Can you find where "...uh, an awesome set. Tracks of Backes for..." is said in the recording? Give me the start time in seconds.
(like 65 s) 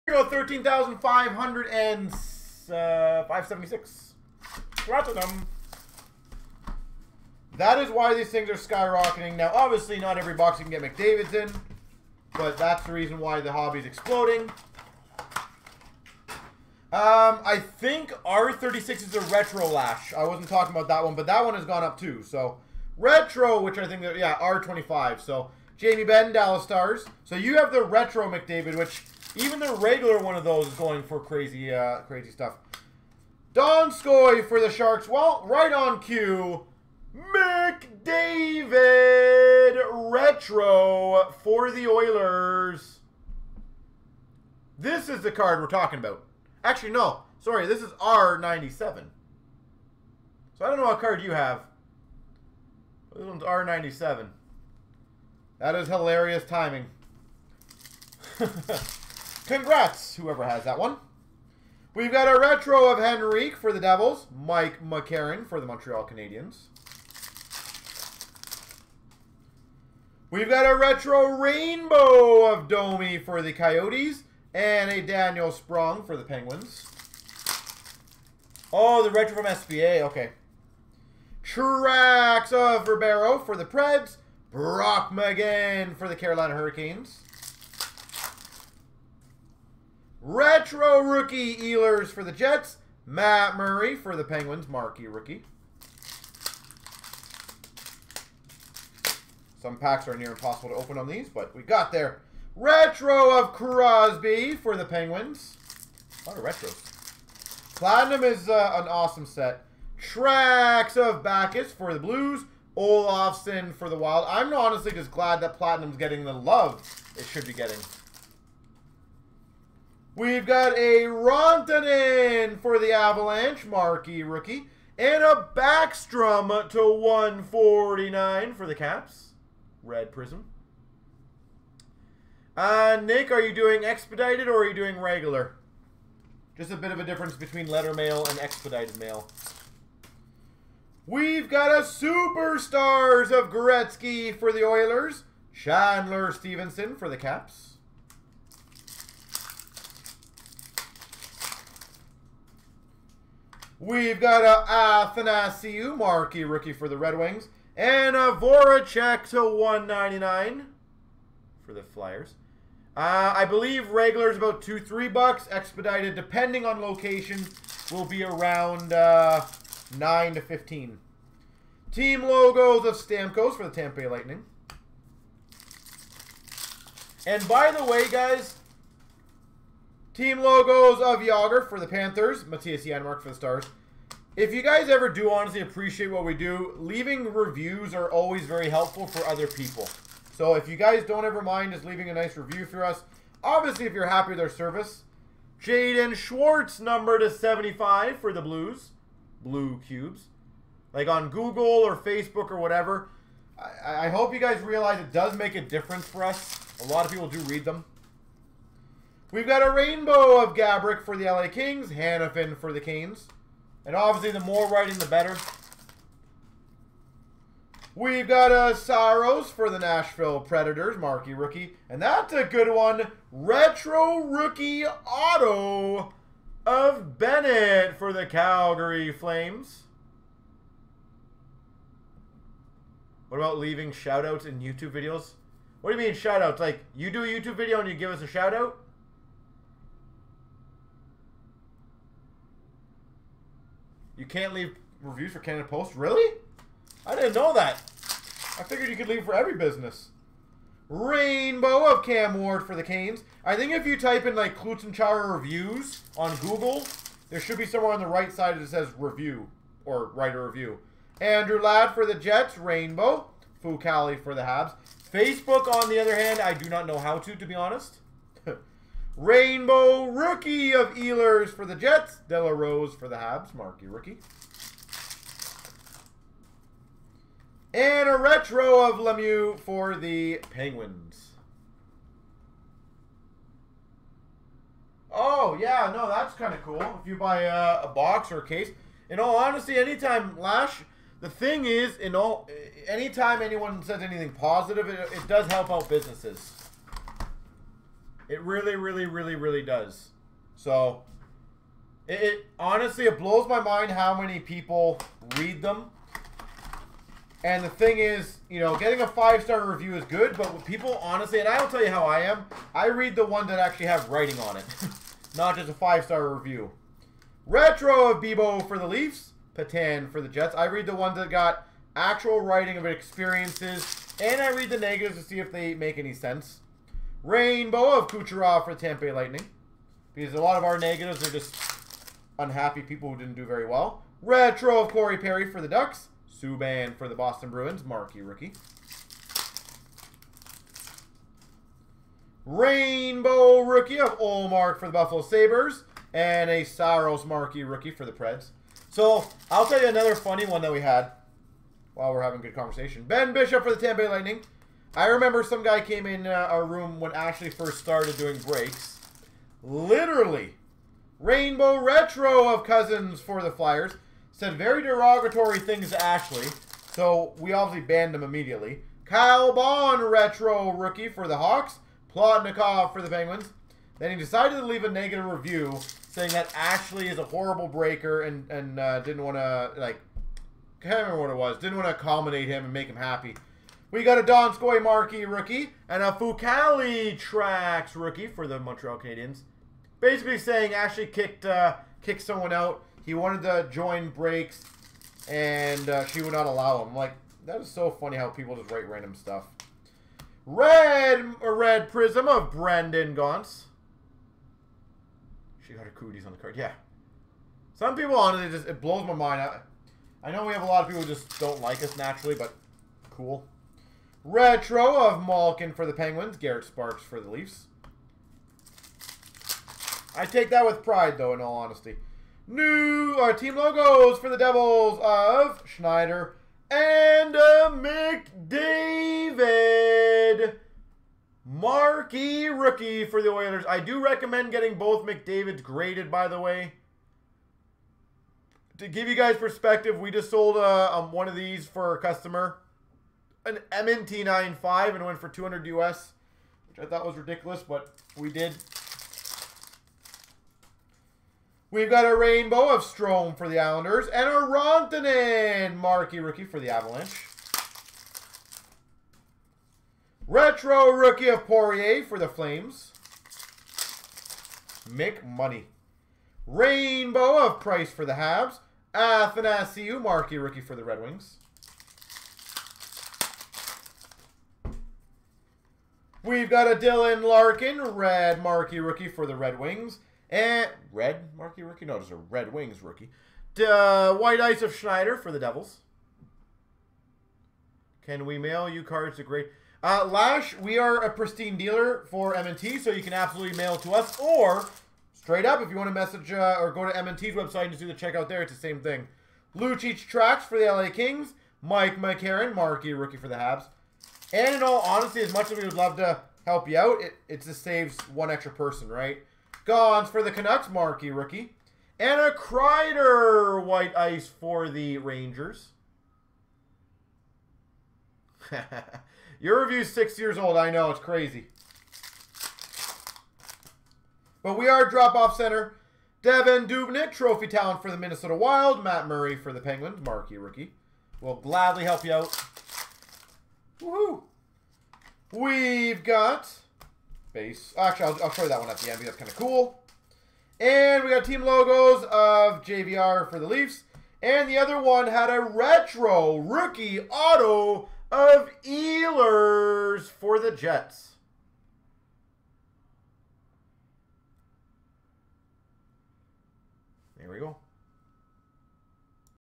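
108 s.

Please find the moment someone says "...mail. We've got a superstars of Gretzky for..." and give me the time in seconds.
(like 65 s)
138 s.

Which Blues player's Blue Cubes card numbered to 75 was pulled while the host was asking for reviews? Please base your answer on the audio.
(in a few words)
Jaden Schwartz.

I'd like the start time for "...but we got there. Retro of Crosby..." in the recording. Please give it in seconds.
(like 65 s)
101 s.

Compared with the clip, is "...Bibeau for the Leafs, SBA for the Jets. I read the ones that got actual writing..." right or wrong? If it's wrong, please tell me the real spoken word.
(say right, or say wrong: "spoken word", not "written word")
wrong: "Petan", not "SBA".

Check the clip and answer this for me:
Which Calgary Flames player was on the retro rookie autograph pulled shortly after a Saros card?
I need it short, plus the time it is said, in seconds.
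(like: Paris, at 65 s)
Bennett, at 227 s.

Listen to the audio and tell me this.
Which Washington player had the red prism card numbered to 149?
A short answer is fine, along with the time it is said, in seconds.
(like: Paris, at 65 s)
Backstrom, at 125 s.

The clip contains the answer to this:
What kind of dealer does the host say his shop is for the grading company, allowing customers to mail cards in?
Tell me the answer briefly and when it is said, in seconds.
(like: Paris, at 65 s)
pristine dealer, at 491 s.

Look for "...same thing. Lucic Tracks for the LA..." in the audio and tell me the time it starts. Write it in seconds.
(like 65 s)
498 s.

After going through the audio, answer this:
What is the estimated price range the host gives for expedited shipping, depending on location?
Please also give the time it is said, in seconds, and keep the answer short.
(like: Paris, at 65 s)
9 to 15, at 169 s.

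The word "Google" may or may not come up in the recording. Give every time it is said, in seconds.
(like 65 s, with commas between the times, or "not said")
201 s, 256 s.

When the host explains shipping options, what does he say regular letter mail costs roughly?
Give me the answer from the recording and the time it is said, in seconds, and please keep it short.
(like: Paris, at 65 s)
2 to 3 bucks, at 164 s.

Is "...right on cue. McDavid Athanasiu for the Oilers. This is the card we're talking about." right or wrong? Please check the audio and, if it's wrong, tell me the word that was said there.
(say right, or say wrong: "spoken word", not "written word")
wrong: "Retro", not "Athanasiu".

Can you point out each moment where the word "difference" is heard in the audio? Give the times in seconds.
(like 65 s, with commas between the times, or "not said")
137 s, 205 s.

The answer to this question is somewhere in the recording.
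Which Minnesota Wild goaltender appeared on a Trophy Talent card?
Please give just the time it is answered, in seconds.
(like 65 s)
526 s.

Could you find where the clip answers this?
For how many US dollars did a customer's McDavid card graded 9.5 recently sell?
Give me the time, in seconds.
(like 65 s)
445 s.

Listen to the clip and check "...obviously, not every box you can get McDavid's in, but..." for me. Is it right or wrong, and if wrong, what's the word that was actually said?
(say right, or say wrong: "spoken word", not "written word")
right.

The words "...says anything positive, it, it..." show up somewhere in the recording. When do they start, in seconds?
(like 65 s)
293 s.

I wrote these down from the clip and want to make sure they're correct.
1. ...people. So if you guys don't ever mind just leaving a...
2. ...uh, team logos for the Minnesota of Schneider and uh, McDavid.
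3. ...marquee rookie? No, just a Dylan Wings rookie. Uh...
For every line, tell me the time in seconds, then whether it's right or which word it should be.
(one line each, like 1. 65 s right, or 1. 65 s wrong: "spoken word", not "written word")
1. 189 s right
2. 423 s wrong: "Devils", not "Minnesota"
3. 481 s wrong: "Red", not "Dylan".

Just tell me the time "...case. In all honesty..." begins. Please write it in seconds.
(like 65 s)
288 s.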